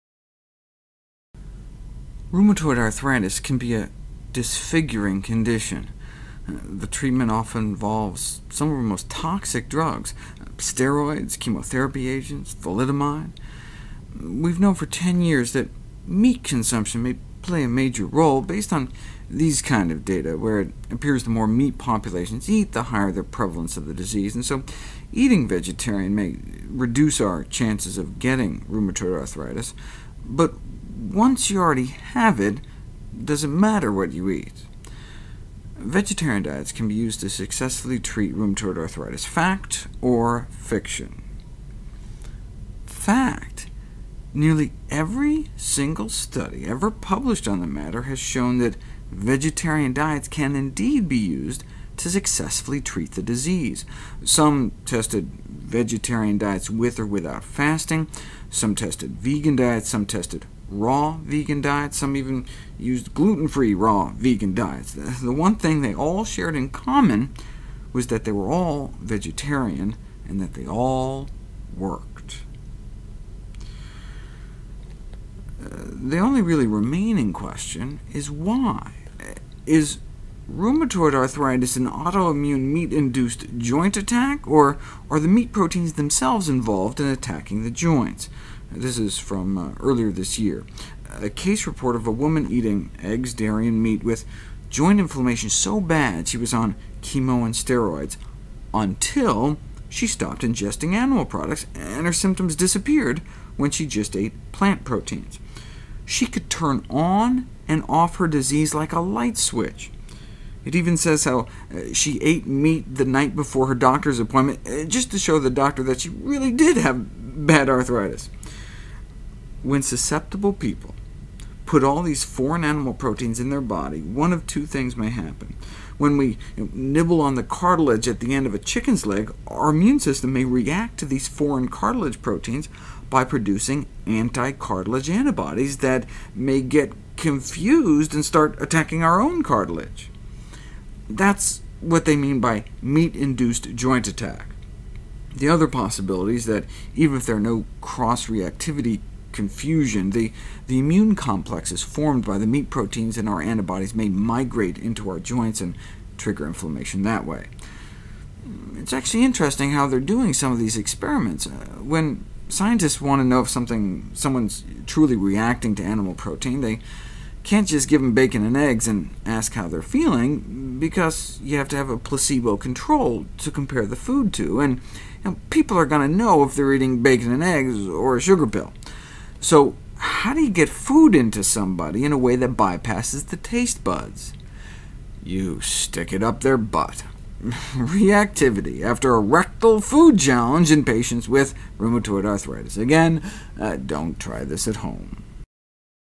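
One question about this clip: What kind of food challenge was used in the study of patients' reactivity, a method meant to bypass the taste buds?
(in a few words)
Rectal food challenge.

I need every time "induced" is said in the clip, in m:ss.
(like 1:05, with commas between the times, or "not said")
1:22, 2:22.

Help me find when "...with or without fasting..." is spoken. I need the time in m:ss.
0:56.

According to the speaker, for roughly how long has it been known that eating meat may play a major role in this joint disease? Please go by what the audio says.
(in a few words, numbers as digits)
10 years.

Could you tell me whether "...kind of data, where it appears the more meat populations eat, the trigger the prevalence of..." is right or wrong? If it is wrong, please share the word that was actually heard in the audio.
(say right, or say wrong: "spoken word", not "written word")
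wrong: "higher", not "trigger".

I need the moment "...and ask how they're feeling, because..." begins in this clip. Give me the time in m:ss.
2:48.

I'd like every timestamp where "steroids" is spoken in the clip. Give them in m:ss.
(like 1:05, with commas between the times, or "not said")
0:10, 1:37.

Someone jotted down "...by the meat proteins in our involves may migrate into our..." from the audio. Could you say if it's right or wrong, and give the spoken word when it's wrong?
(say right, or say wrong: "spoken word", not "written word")
wrong: "antibodies", not "involves".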